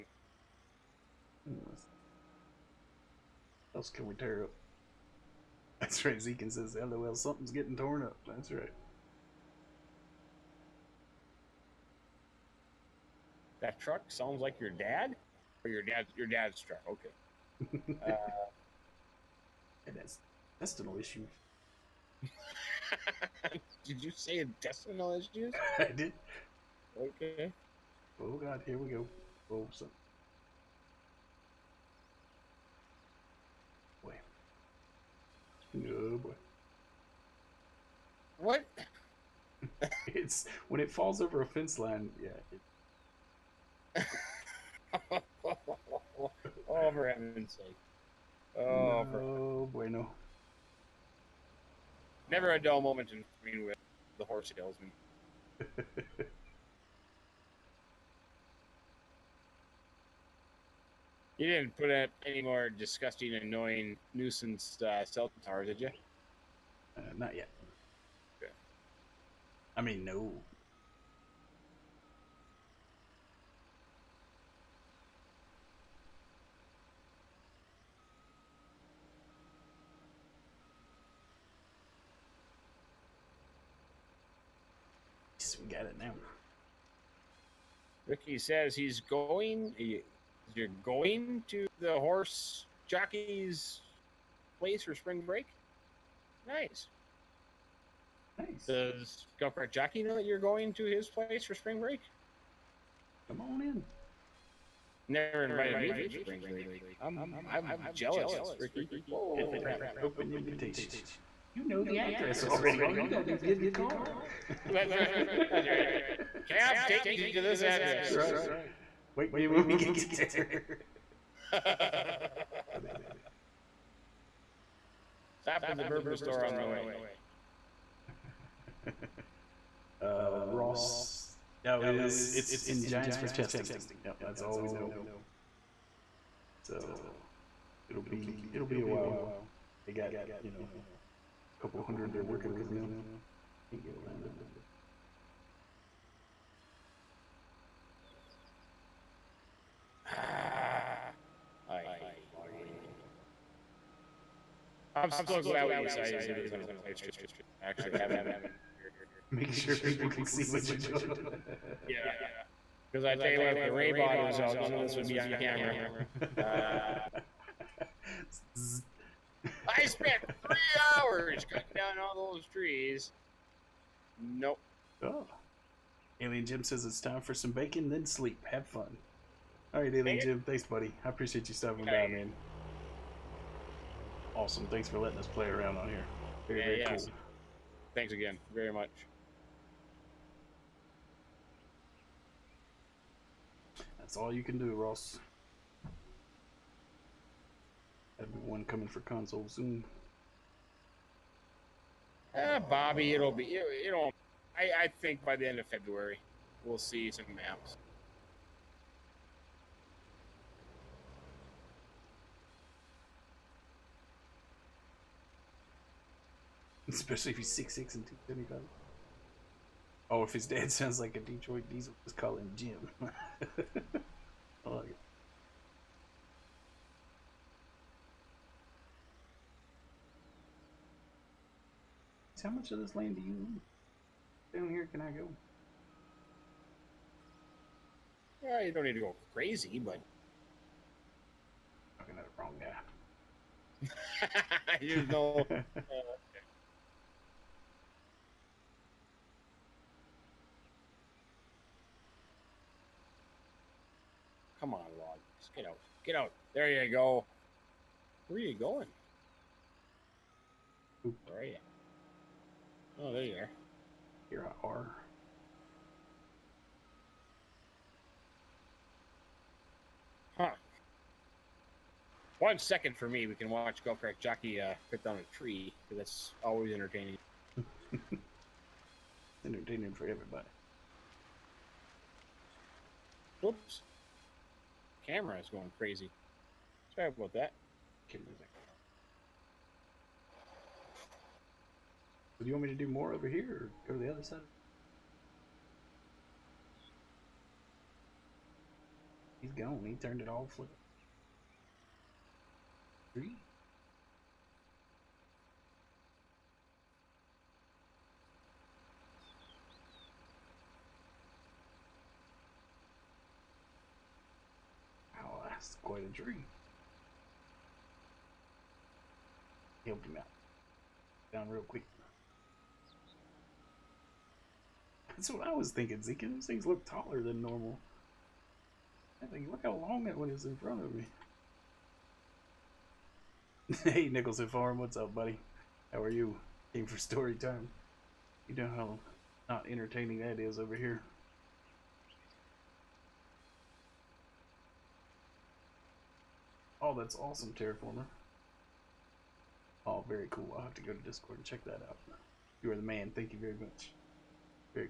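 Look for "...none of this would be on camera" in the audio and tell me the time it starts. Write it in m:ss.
2:44.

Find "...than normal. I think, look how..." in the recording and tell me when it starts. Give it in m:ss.
5:27.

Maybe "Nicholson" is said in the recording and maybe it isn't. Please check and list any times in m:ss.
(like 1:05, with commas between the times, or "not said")
5:34.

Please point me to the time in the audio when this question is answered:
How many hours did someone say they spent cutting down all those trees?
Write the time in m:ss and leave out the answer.
2:50.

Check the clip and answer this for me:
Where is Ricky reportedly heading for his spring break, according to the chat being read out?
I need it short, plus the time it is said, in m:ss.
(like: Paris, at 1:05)
The horse jockey's place, at 1:31.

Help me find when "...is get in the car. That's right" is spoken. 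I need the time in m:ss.
1:53.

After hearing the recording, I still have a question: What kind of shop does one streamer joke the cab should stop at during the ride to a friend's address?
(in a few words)
The bourbon store.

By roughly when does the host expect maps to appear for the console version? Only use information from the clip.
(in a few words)
End of February.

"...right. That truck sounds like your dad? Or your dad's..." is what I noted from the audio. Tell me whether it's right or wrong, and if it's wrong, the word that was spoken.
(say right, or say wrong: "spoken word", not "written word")
right.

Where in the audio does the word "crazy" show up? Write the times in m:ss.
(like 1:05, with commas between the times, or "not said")
3:59, 4:45.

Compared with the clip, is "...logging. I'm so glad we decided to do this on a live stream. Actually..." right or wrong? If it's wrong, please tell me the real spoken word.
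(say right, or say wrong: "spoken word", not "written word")
right.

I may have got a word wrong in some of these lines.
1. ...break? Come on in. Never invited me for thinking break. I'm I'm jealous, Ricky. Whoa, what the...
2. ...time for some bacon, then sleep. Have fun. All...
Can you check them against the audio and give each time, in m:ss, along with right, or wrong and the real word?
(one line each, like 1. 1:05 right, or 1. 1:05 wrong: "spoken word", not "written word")
1. 1:41 wrong: "spring", not "thinking"
2. 2:57 right.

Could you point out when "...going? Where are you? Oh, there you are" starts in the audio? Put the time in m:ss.
4:18.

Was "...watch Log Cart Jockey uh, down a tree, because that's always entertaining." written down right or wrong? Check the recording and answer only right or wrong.
wrong.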